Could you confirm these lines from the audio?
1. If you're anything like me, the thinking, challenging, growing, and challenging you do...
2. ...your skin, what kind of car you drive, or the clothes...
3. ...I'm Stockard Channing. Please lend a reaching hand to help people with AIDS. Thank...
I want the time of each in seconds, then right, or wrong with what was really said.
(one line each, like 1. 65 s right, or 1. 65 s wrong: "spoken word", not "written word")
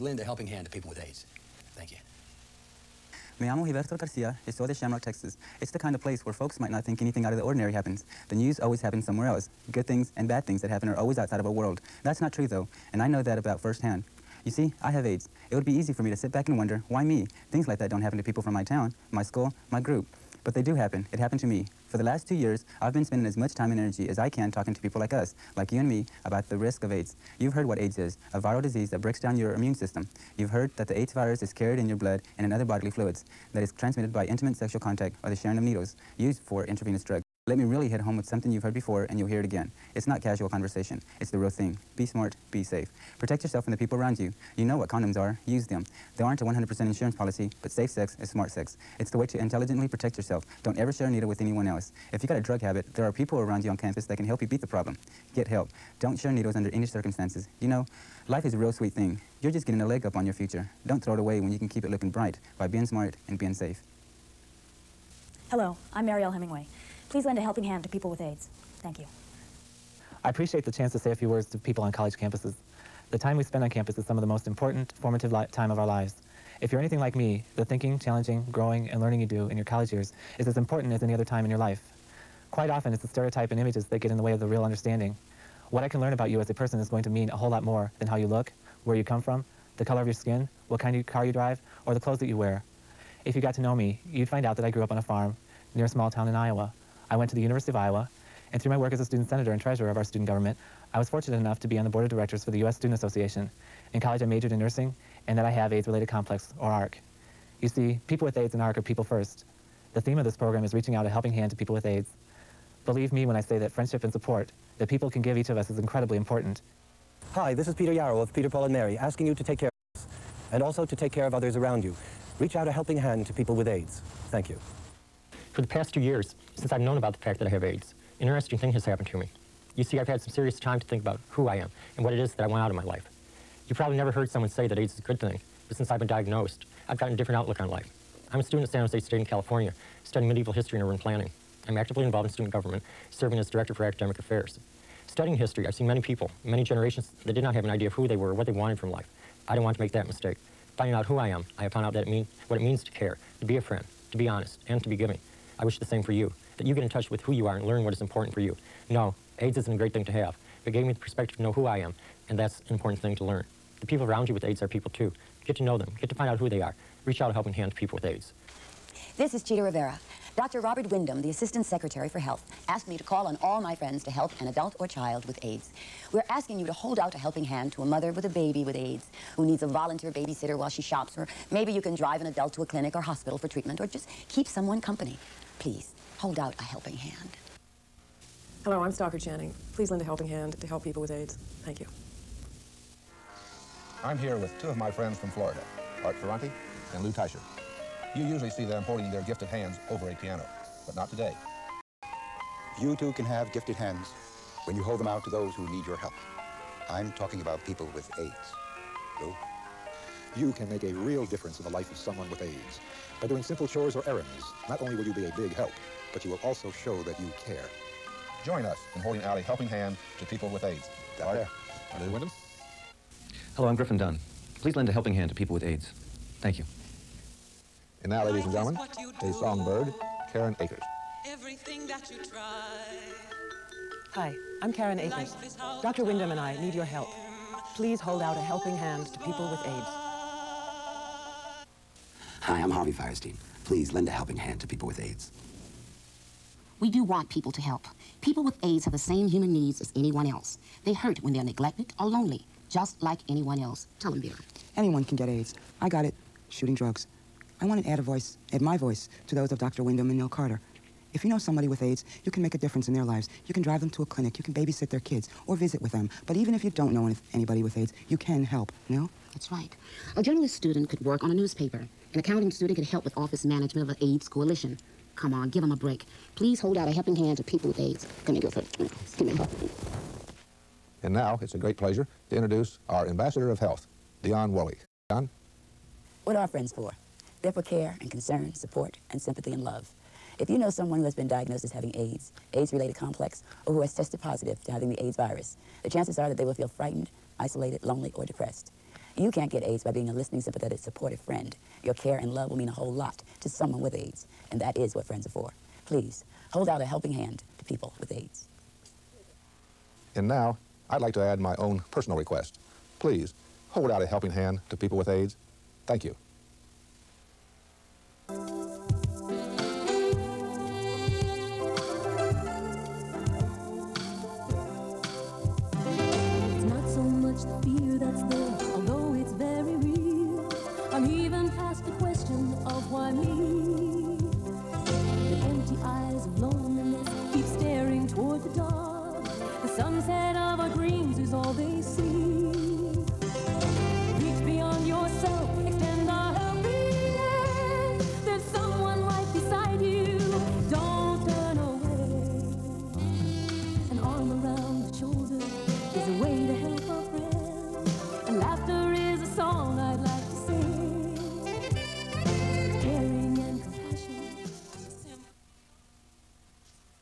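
1. 76 s wrong: "learning", not "challenging"
2. 90 s right
3. 188 s wrong: "helping", not "reaching".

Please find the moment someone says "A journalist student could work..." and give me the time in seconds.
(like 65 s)
270 s.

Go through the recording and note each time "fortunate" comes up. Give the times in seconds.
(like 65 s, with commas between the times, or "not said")
101 s.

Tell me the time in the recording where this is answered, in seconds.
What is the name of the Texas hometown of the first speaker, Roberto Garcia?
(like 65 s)
4 s.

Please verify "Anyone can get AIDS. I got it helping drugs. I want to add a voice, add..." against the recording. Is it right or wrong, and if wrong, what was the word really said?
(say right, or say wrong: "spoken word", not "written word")
wrong: "shooting", not "helping".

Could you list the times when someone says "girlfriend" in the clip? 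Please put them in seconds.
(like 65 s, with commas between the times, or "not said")
278 s.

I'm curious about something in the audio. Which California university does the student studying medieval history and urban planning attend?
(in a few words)
San Jose State.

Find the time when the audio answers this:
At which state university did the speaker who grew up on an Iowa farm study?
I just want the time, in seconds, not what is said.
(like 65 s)
97 s.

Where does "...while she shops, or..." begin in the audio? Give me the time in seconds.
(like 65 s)
180 s.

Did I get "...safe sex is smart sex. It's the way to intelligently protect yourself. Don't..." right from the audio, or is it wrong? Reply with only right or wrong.
right.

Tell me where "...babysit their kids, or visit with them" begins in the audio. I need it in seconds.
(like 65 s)
264 s.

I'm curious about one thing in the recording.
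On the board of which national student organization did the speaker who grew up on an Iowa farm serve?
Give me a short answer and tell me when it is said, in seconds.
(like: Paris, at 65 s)
U.S. Student Association, at 102 s.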